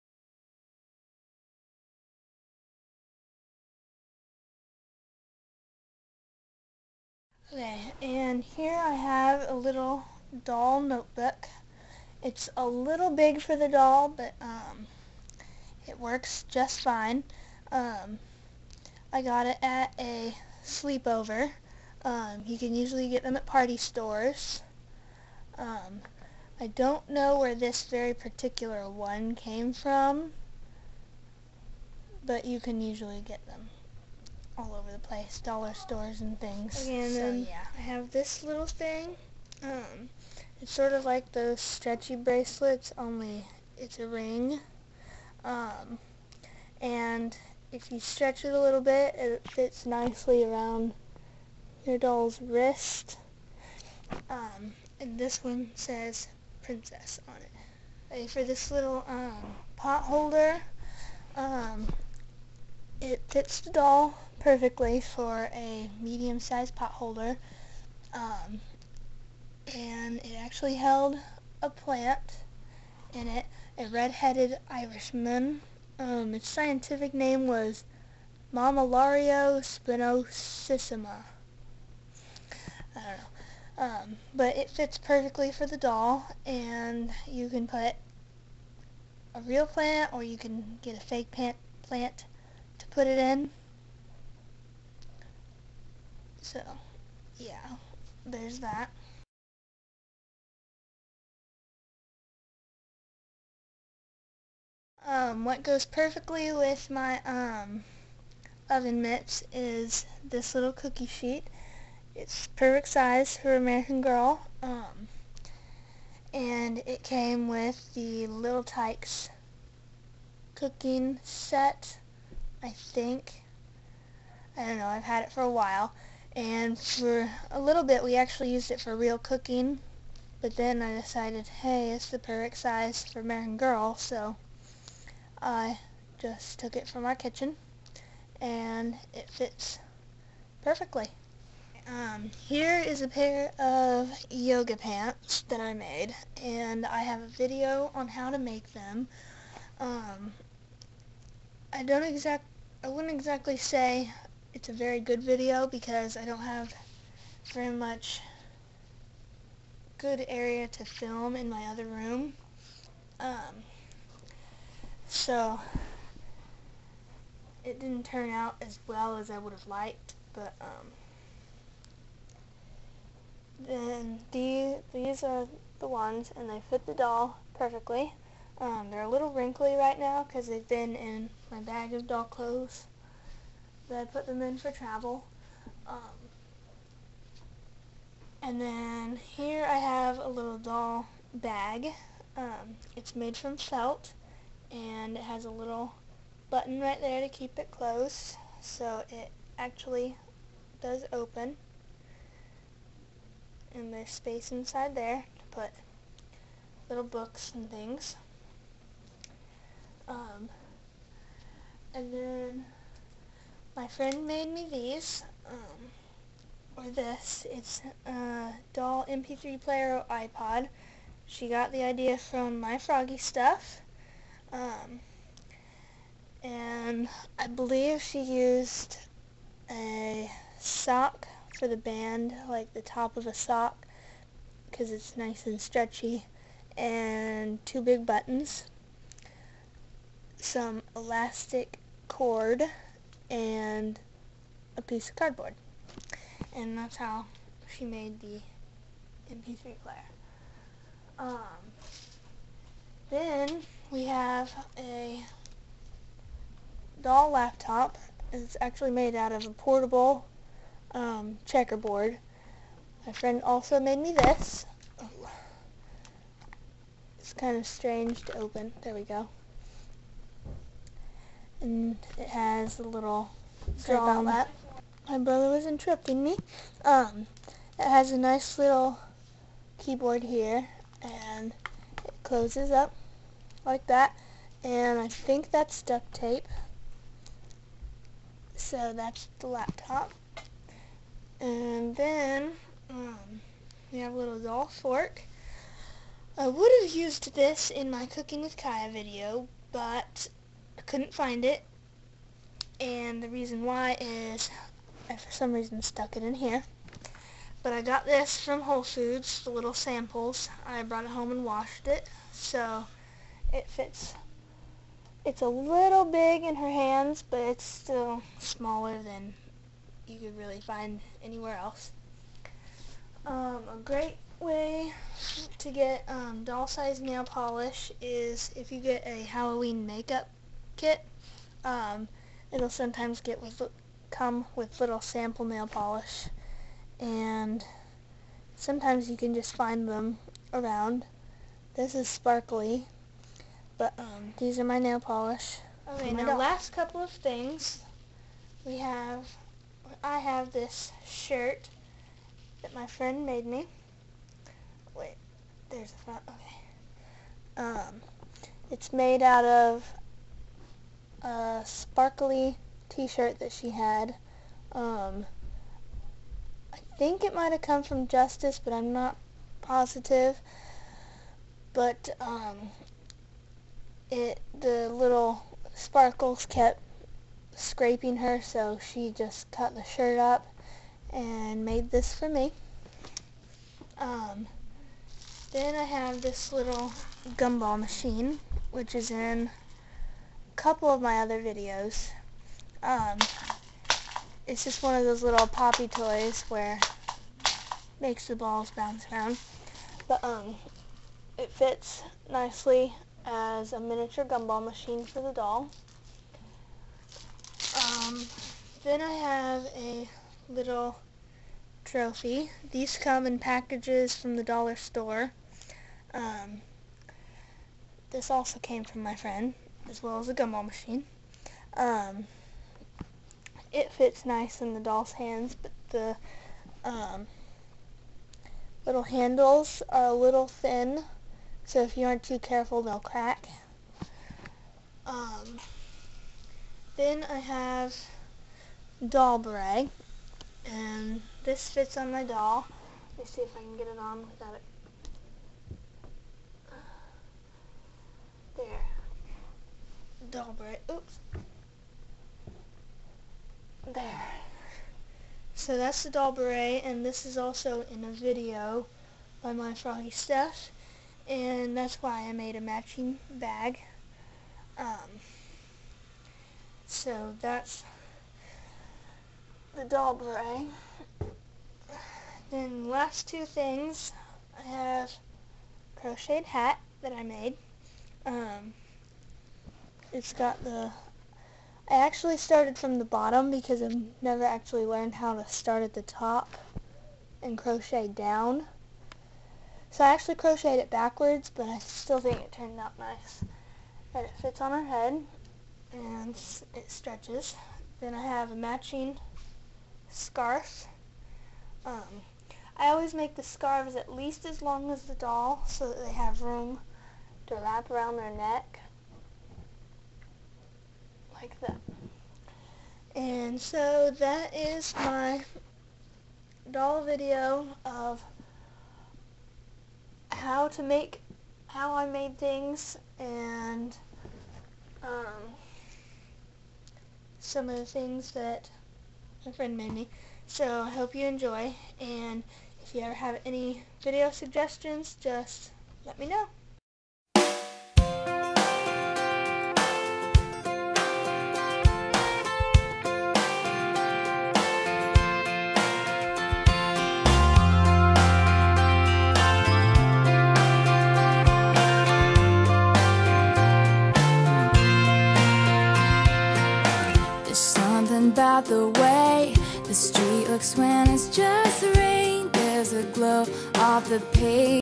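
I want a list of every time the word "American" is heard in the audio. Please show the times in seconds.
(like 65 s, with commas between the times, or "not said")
113 s, 133 s.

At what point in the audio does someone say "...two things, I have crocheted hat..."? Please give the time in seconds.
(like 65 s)
473 s.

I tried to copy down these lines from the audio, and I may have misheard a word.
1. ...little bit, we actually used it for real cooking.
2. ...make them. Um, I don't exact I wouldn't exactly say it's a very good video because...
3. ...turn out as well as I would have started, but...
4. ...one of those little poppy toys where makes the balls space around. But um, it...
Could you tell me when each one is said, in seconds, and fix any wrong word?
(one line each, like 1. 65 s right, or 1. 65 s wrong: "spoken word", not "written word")
1. 127 s right
2. 148 s right
3. 168 s wrong: "liked", not "started"
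4. 394 s wrong: "bounce", not "space".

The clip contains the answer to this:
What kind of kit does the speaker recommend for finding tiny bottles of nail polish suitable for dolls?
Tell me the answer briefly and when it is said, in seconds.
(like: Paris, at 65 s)
Halloween makeup kit, at 329 s.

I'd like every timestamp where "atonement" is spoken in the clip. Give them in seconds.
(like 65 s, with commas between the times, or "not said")
not said.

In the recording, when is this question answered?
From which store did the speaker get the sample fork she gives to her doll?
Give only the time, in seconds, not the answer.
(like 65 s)
308 s.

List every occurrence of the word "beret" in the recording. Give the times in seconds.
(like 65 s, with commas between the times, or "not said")
439 s, 456 s, 470 s.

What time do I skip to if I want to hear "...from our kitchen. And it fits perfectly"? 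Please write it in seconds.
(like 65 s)
136 s.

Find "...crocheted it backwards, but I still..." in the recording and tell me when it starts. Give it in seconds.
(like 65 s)
490 s.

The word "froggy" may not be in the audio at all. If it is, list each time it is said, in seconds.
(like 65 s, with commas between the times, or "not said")
222 s, 459 s.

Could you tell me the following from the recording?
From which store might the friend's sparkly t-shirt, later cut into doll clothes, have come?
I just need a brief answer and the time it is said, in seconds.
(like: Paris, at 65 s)
Justice, at 368 s.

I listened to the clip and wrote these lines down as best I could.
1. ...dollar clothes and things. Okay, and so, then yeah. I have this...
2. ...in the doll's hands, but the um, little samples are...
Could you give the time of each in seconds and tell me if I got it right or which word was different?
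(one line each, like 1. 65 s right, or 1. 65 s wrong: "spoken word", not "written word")
1. 35 s wrong: "stores", not "clothes"
2. 424 s wrong: "handles", not "samples".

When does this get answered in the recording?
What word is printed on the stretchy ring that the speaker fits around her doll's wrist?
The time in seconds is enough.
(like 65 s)
56 s.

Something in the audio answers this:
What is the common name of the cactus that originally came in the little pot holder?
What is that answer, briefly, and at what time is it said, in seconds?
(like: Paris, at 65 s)
Red-headed Irishman, at 73 s.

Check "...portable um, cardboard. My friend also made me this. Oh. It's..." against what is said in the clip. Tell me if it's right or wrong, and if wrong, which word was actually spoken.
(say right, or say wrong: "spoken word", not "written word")
wrong: "checkerboard", not "cardboard".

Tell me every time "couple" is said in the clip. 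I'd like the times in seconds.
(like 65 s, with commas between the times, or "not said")
346 s, 390 s.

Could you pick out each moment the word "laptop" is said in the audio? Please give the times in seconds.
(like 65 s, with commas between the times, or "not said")
257 s, 289 s.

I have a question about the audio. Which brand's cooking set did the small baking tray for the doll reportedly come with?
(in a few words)
Little Tikes.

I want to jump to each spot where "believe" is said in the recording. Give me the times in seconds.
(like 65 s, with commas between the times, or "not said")
227 s.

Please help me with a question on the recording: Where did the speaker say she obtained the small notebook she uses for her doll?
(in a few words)
At a sleepover.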